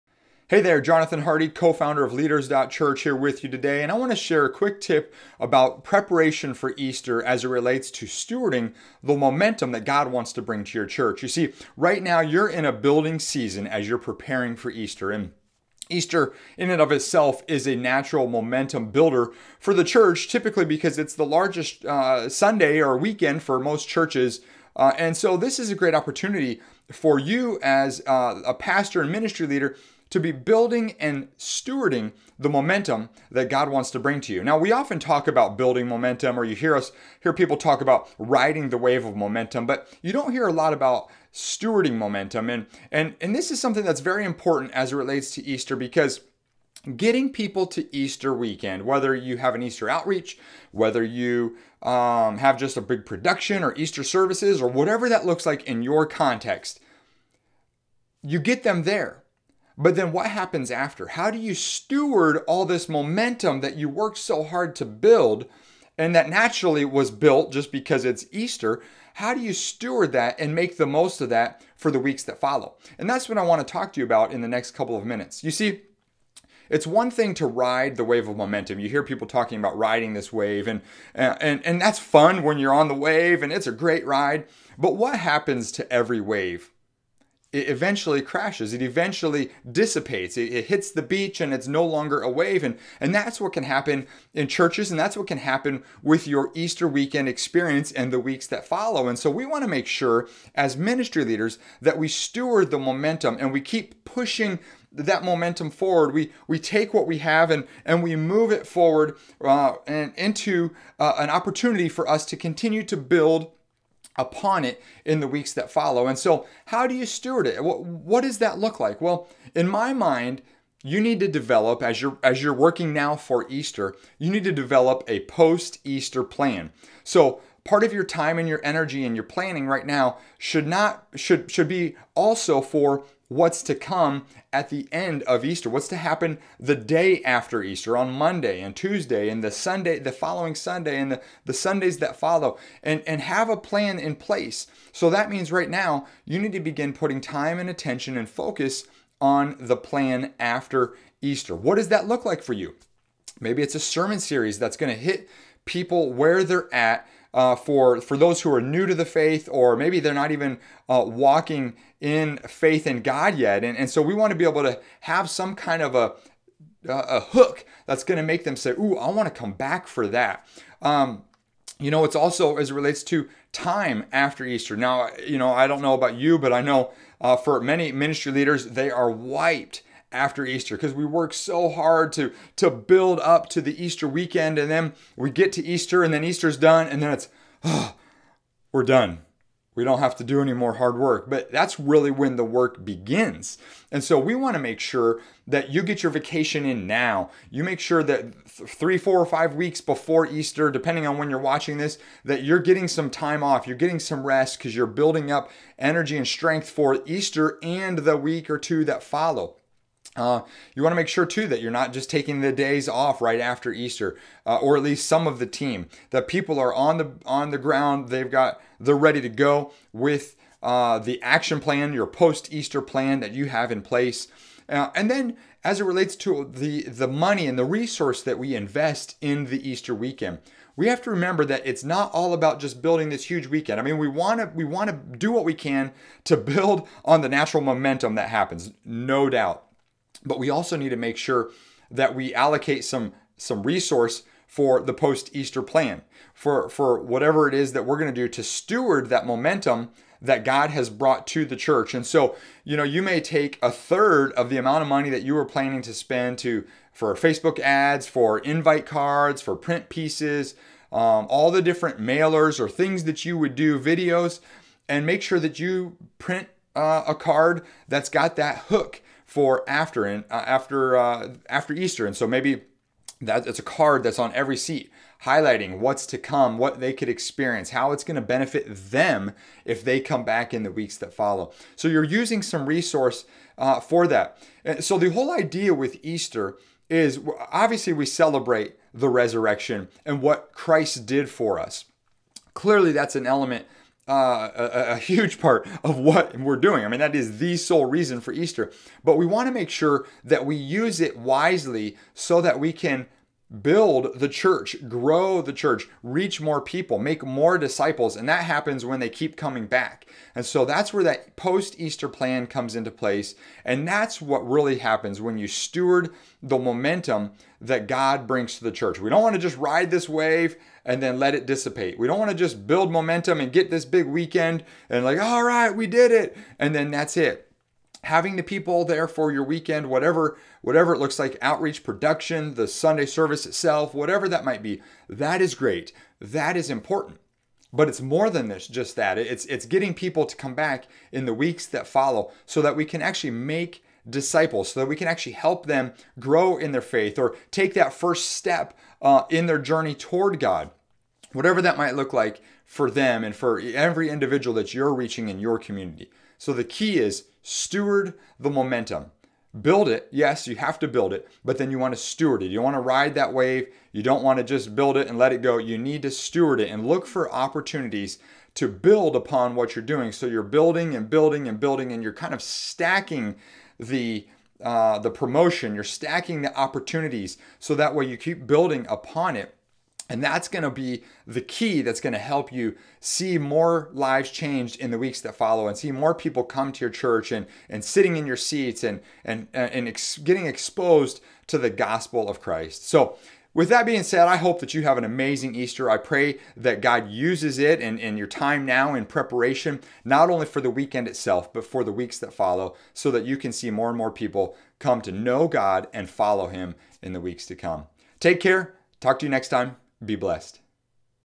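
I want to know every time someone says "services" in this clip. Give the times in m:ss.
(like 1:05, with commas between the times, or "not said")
0:54, 5:33.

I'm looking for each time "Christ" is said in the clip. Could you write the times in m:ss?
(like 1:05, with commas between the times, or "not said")
4:50, 6:32.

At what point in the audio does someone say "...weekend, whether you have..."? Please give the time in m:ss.
0:48.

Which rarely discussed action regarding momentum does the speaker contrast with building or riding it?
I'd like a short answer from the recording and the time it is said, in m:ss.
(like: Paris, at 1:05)
Stewarding momentum, at 0:41.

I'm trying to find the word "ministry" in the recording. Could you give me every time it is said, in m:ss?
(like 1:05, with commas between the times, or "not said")
0:29, 1:40, 2:57.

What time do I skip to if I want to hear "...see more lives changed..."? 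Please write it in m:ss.
6:22.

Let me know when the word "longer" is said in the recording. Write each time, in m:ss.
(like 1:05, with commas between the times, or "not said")
1:31.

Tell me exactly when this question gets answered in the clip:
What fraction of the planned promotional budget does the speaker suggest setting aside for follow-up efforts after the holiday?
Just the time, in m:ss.
4:13.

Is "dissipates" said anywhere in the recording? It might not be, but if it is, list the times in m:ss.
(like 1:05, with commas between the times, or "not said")
1:29, 5:21.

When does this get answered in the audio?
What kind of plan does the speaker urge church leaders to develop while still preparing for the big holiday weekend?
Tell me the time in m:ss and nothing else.
2:05.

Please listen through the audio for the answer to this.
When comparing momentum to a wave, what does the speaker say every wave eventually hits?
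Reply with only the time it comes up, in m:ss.
1:30.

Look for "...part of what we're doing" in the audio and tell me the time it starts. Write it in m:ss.
4:55.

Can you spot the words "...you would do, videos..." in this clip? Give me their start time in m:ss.
4:23.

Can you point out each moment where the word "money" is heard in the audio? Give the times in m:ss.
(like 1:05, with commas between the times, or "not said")
3:47, 4:14.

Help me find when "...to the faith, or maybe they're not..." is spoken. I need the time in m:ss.
2:38.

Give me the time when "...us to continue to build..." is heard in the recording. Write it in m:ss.
1:52.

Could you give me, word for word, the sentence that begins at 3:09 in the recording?
We don't have to do any more hard work.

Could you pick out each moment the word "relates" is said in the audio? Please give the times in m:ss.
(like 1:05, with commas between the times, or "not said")
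0:07, 0:44, 2:52, 3:45.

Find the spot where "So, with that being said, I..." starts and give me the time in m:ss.
6:32.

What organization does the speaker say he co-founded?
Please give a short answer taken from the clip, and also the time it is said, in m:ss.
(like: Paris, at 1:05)
Leaders.Church, at 0:02.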